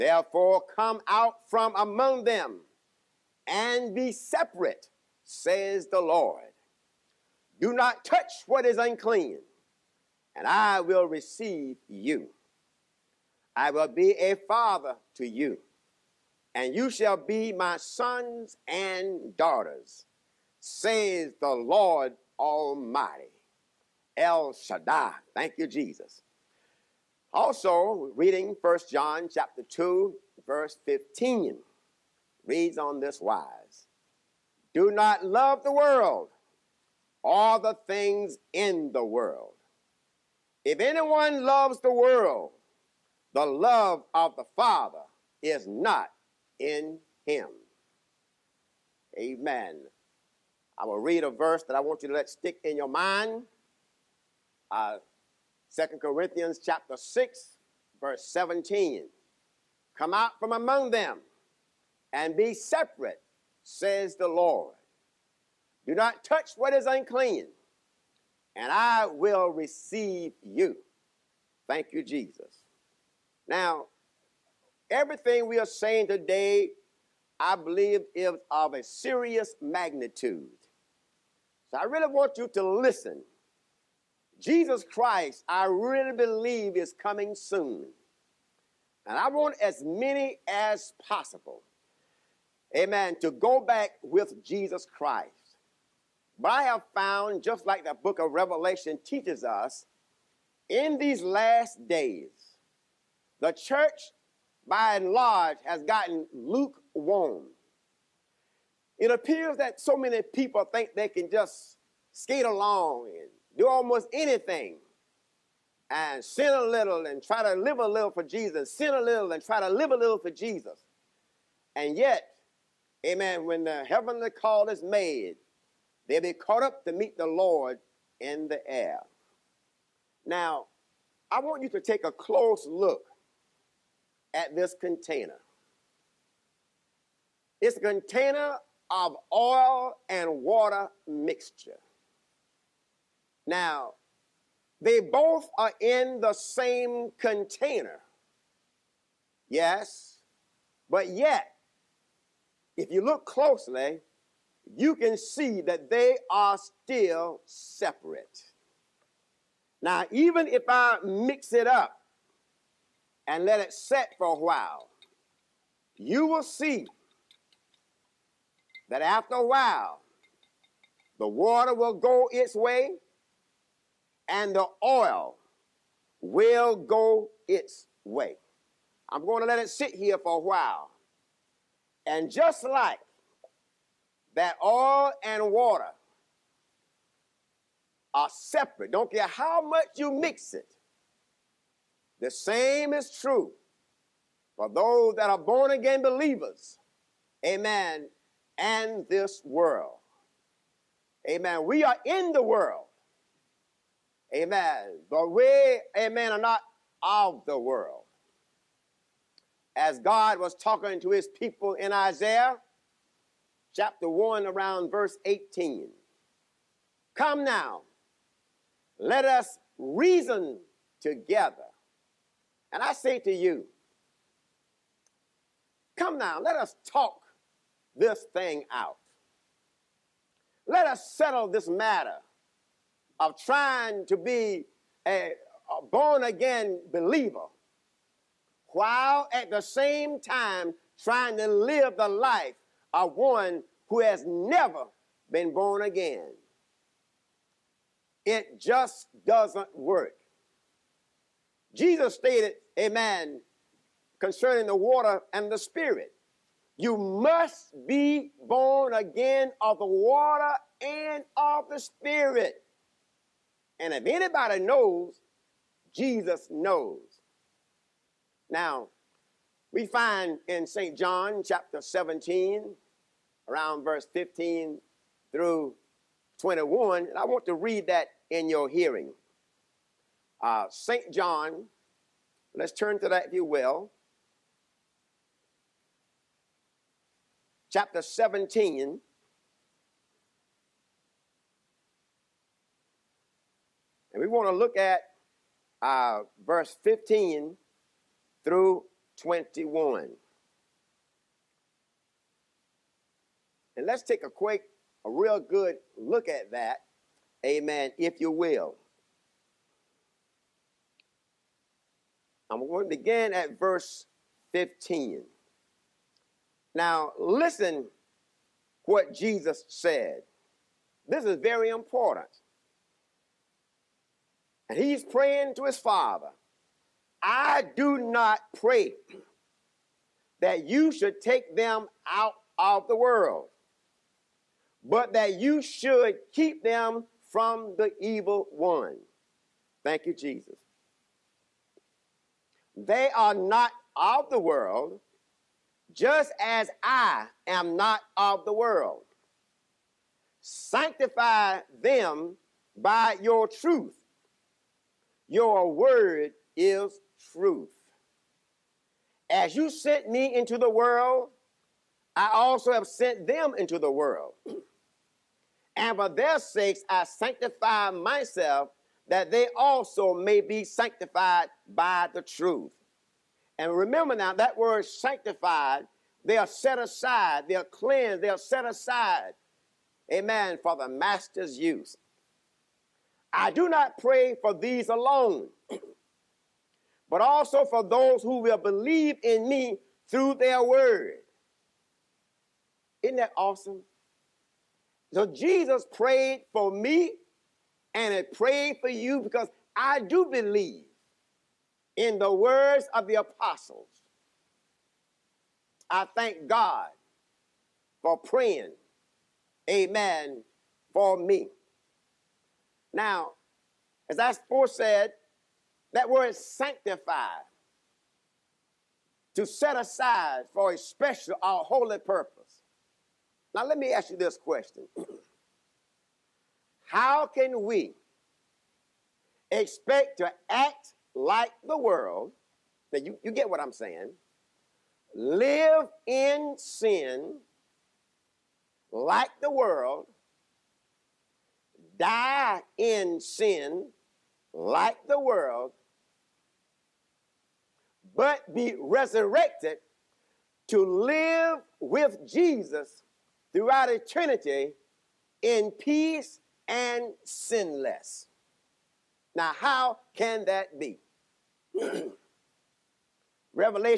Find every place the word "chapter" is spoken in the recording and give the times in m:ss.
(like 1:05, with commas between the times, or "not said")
0:29, 0:56, 3:33, 4:31, 4:47.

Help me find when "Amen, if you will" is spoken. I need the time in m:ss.
5:07.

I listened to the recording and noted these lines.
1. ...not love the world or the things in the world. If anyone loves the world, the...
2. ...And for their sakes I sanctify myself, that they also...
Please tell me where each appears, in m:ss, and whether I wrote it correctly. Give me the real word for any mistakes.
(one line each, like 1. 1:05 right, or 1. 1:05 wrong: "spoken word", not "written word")
1. 0:34 right
2. 6:05 right.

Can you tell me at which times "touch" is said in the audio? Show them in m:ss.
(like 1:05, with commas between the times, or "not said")
0:08, 1:06.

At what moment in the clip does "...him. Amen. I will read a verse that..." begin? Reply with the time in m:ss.
0:47.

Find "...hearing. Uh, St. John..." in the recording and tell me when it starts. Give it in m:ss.
4:38.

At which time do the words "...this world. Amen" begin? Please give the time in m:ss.
3:19.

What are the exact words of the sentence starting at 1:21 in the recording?
So I really want you to listen.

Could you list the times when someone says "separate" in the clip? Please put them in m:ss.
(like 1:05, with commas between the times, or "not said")
0:04, 1:02, 2:37, 3:08.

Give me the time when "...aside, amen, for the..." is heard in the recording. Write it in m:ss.
6:18.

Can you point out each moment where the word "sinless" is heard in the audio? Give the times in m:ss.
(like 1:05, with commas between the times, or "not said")
7:37.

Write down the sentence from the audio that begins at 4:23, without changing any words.
And if anybody knows, Jesus knows.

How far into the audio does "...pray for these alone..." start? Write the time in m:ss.
6:23.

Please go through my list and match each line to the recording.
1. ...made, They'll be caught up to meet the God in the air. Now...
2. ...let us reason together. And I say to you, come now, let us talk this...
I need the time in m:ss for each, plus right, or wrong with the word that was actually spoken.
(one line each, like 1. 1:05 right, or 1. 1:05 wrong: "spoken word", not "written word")
1. 2:04 wrong: "Lord", not "God"
2. 3:38 right.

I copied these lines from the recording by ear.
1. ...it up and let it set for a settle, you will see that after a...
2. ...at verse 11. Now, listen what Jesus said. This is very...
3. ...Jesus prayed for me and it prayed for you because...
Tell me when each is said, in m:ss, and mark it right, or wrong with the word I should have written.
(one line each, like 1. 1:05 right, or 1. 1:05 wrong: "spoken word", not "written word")
1. 2:41 wrong: "while", not "settle"
2. 5:13 wrong: "15", not "11"
3. 6:35 right.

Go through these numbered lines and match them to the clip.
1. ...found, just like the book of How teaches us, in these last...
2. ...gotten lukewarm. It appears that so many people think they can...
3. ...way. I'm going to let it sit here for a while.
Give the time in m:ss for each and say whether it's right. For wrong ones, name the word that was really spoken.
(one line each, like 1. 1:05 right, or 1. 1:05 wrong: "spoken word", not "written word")
1. 1:36 wrong: "Revelation", not "How"
2. 1:45 right
3. 2:58 right.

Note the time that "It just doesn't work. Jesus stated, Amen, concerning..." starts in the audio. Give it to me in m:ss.
4:08.